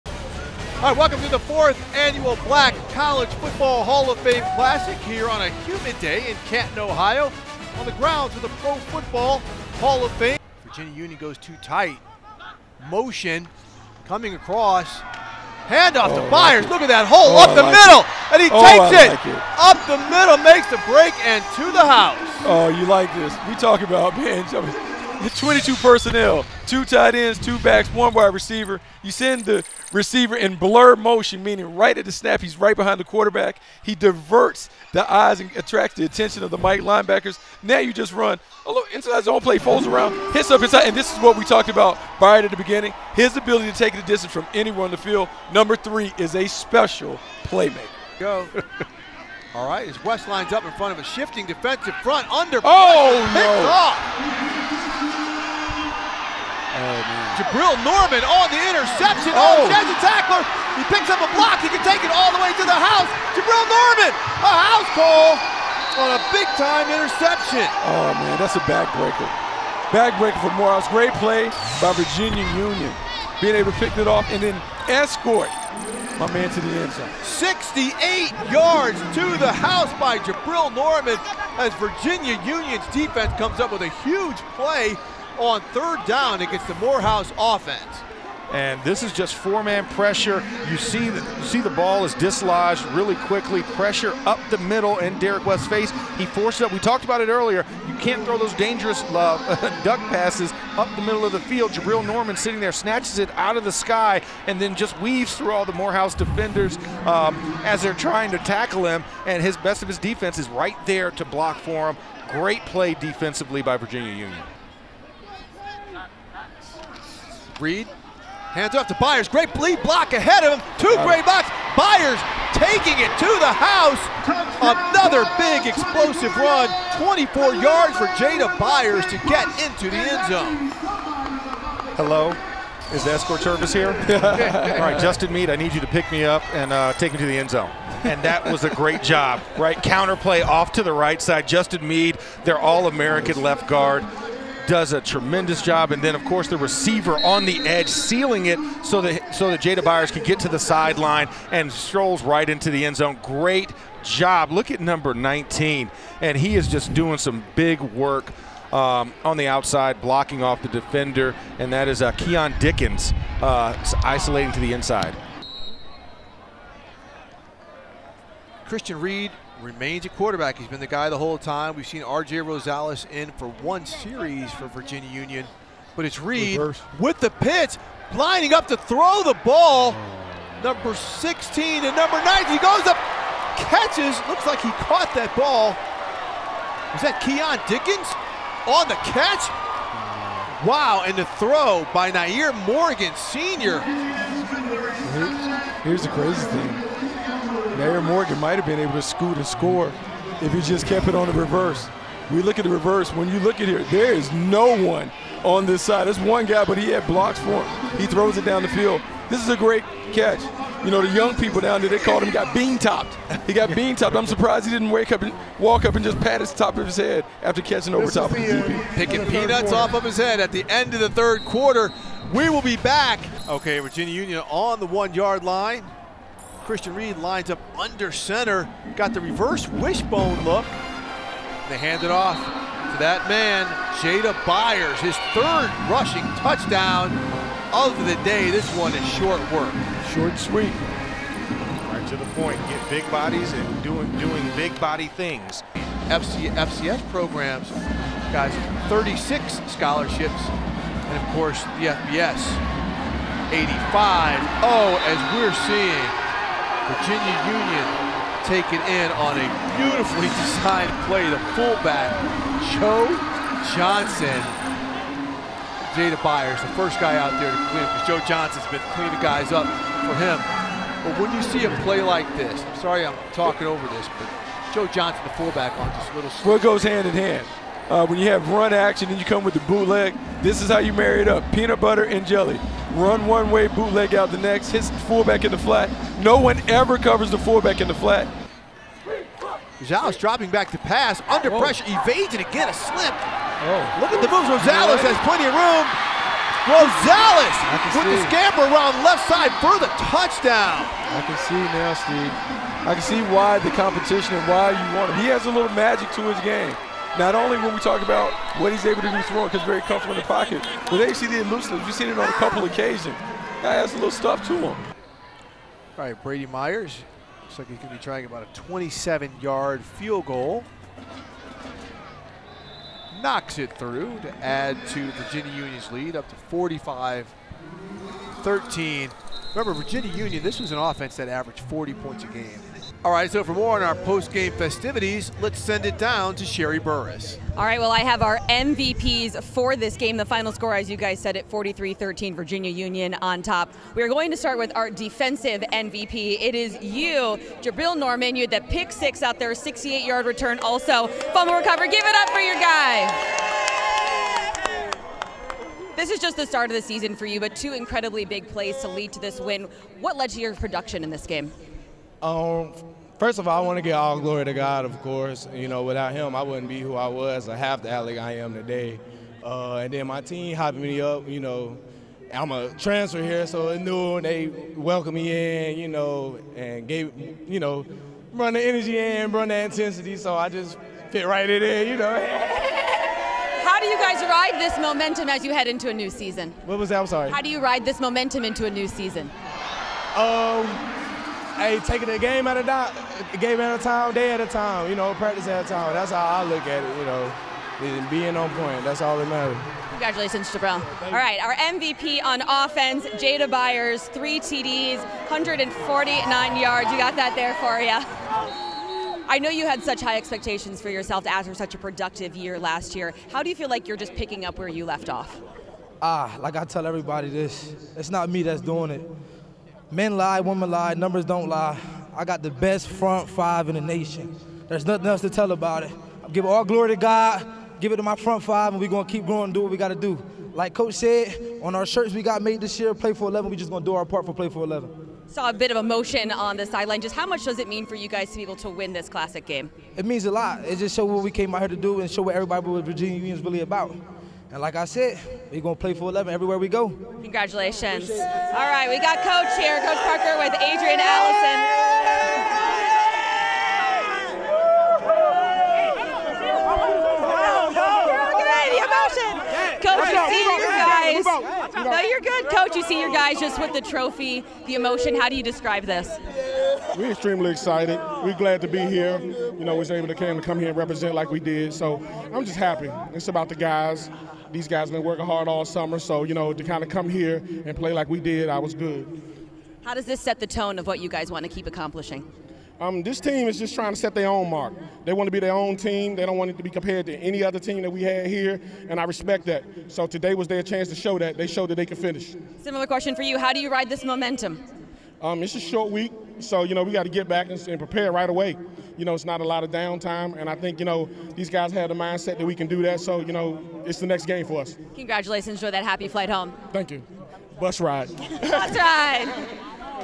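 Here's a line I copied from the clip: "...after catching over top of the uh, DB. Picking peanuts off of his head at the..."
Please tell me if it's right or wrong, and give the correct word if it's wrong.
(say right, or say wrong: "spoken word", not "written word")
right.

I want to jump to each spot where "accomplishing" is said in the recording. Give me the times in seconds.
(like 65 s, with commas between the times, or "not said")
481 s.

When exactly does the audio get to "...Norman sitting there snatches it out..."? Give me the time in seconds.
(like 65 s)
102 s.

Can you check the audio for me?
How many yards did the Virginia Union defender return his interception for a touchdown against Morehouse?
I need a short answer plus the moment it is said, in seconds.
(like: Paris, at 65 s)
68, at 77 s.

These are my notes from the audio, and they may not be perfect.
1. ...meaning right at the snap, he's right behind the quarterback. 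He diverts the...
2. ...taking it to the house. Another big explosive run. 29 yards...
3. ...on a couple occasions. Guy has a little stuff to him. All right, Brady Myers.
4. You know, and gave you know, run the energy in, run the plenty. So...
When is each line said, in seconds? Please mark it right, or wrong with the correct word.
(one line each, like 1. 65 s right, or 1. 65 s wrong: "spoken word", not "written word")
1. 31 s right
2. 122 s wrong: "24", not "29"
3. 312 s right
4. 375 s wrong: "intensity", not "plenty".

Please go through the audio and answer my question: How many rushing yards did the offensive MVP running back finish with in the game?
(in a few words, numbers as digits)
149.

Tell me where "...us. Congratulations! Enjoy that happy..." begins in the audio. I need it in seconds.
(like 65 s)
504 s.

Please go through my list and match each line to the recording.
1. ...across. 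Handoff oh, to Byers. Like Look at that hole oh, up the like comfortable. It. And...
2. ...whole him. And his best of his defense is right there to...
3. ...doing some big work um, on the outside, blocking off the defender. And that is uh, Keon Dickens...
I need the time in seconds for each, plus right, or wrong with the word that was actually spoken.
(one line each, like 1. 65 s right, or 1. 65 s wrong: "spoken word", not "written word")
1. 14 s wrong: "middle", not "comfortable"
2. 108 s wrong: "tackle", not "whole"
3. 156 s right.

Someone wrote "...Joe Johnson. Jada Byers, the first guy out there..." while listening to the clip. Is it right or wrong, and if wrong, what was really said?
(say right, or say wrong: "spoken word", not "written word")
right.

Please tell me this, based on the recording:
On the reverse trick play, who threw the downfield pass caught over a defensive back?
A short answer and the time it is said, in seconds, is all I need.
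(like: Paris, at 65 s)
Nair Morgan Sr., at 192 s.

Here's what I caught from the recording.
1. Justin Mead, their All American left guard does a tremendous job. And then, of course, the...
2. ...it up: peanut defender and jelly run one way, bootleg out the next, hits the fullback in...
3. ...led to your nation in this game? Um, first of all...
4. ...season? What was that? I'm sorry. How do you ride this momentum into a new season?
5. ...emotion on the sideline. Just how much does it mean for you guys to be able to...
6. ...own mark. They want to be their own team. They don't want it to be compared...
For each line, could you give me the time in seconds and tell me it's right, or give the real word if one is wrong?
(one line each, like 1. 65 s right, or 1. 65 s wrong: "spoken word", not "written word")
1. 141 s right
2. 281 s wrong: "butter", not "defender"
3. 360 s wrong: "production", not "nation"
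4. 386 s right
5. 435 s right
6. 484 s right.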